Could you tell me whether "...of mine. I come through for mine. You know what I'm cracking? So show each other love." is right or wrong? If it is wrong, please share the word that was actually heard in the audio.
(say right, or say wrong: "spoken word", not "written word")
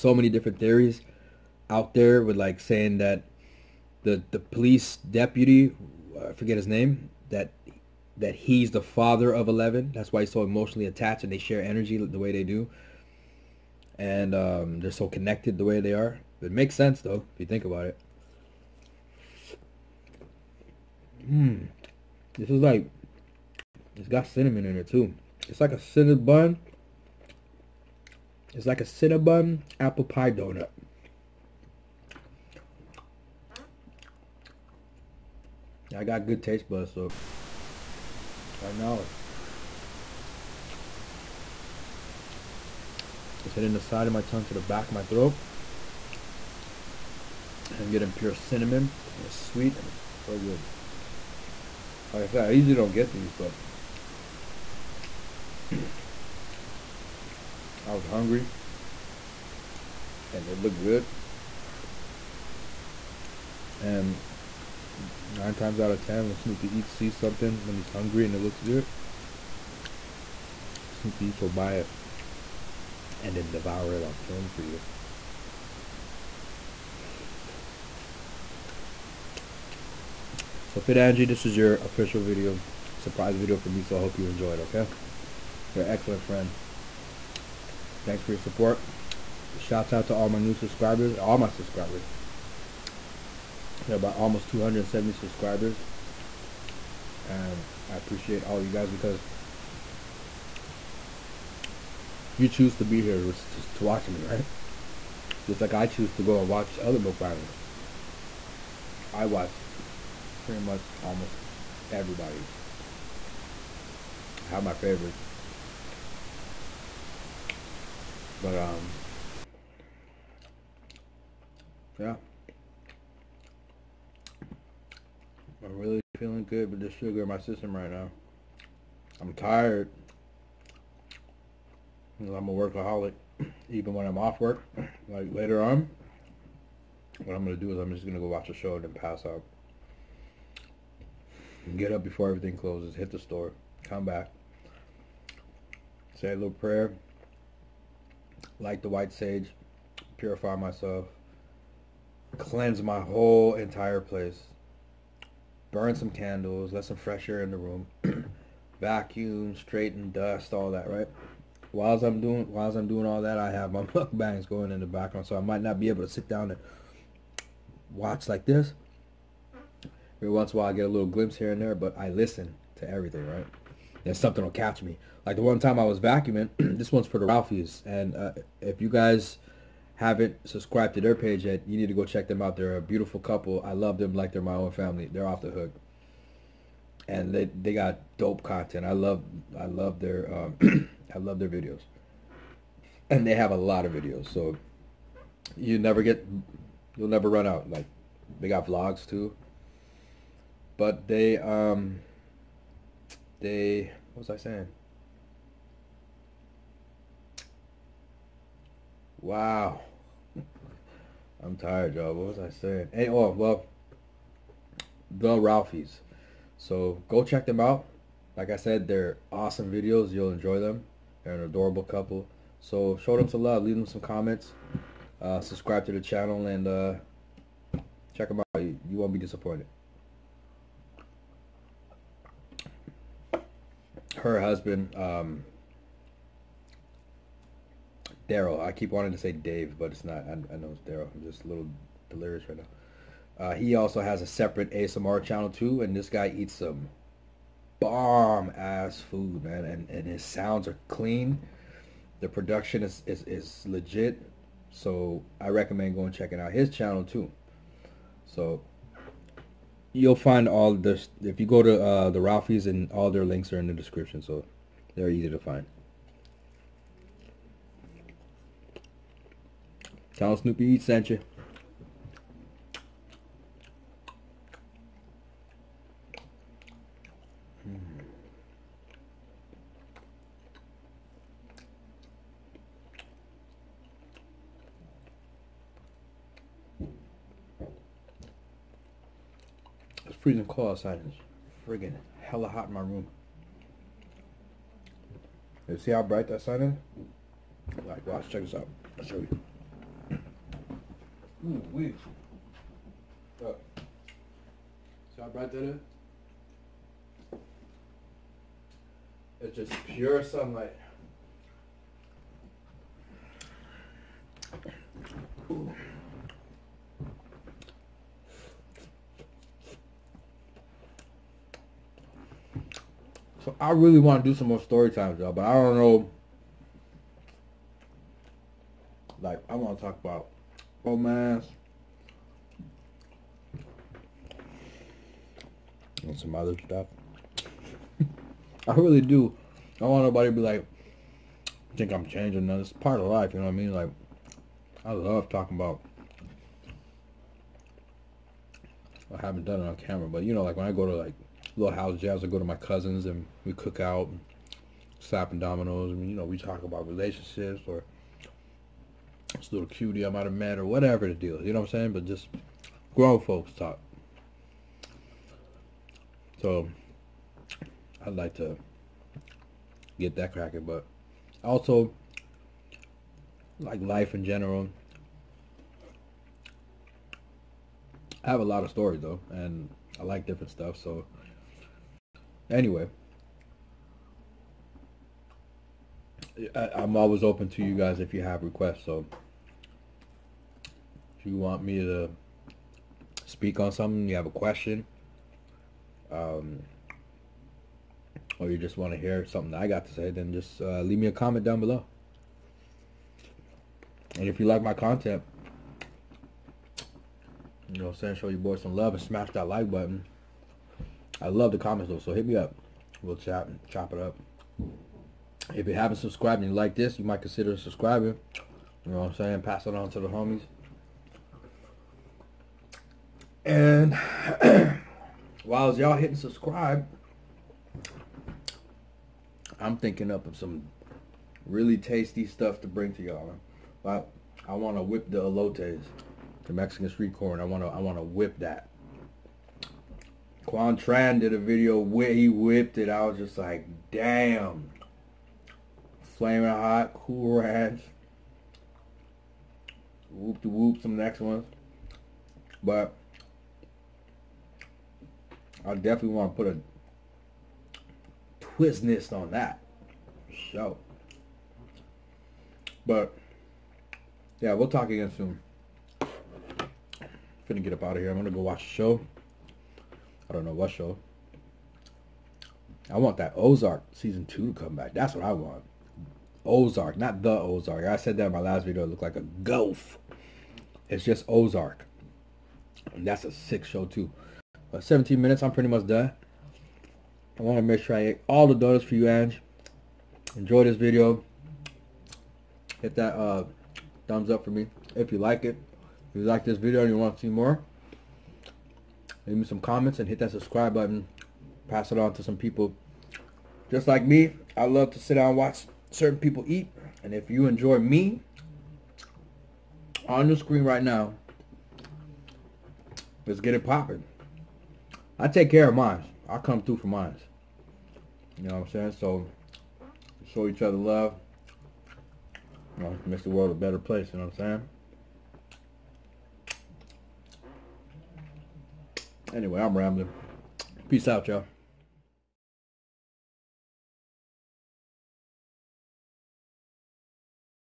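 wrong: "saying", not "cracking".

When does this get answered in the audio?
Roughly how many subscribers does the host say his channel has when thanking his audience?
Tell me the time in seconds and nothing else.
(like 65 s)
94 s.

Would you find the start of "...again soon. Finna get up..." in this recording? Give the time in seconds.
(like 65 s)
464 s.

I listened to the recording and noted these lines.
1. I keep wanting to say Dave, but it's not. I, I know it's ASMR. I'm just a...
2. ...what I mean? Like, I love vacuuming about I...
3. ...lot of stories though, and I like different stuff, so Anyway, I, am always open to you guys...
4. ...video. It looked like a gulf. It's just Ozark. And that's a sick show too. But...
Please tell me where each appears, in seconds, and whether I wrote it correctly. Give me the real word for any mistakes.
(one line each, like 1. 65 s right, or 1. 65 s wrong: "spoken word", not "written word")
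1. 238 s wrong: "Daryl", not "ASMR"
2. 343 s wrong: "talking", not "vacuuming"
3. 378 s right
4. 478 s right.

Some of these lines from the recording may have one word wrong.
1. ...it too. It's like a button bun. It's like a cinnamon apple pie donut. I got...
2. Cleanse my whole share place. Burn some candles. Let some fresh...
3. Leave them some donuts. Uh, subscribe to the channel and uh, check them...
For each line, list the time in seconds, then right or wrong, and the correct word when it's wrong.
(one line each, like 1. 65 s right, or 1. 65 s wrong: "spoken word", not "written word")
1. 24 s wrong: "cinnamon", not "button"
2. 152 s wrong: "entire", not "share"
3. 223 s wrong: "comments", not "donuts".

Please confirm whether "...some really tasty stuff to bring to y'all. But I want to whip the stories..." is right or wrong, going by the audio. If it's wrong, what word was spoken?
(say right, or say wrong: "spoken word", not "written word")
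wrong: "elotes", not "stories".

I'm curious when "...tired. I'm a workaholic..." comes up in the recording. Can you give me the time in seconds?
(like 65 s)
129 s.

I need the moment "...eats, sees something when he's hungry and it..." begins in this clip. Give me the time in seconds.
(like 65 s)
66 s.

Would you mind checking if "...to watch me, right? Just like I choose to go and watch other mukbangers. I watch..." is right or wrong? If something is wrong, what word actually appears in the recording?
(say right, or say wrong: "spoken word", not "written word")
right.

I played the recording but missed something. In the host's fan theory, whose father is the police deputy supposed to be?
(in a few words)
Eleven.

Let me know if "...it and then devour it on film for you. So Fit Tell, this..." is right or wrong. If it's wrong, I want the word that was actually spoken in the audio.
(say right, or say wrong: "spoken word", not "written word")
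wrong: "Angie", not "Tell".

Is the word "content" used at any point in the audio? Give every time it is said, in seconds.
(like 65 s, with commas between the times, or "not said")
188 s, 404 s.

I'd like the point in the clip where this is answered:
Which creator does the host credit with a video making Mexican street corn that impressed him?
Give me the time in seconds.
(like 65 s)
440 s.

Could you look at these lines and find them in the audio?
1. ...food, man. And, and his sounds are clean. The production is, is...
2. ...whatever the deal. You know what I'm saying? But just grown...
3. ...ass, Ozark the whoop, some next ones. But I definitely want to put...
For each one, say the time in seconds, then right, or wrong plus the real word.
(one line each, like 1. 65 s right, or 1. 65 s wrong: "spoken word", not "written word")
1. 249 s right
2. 360 s right
3. 447 s wrong: "Whoop", not "Ozark".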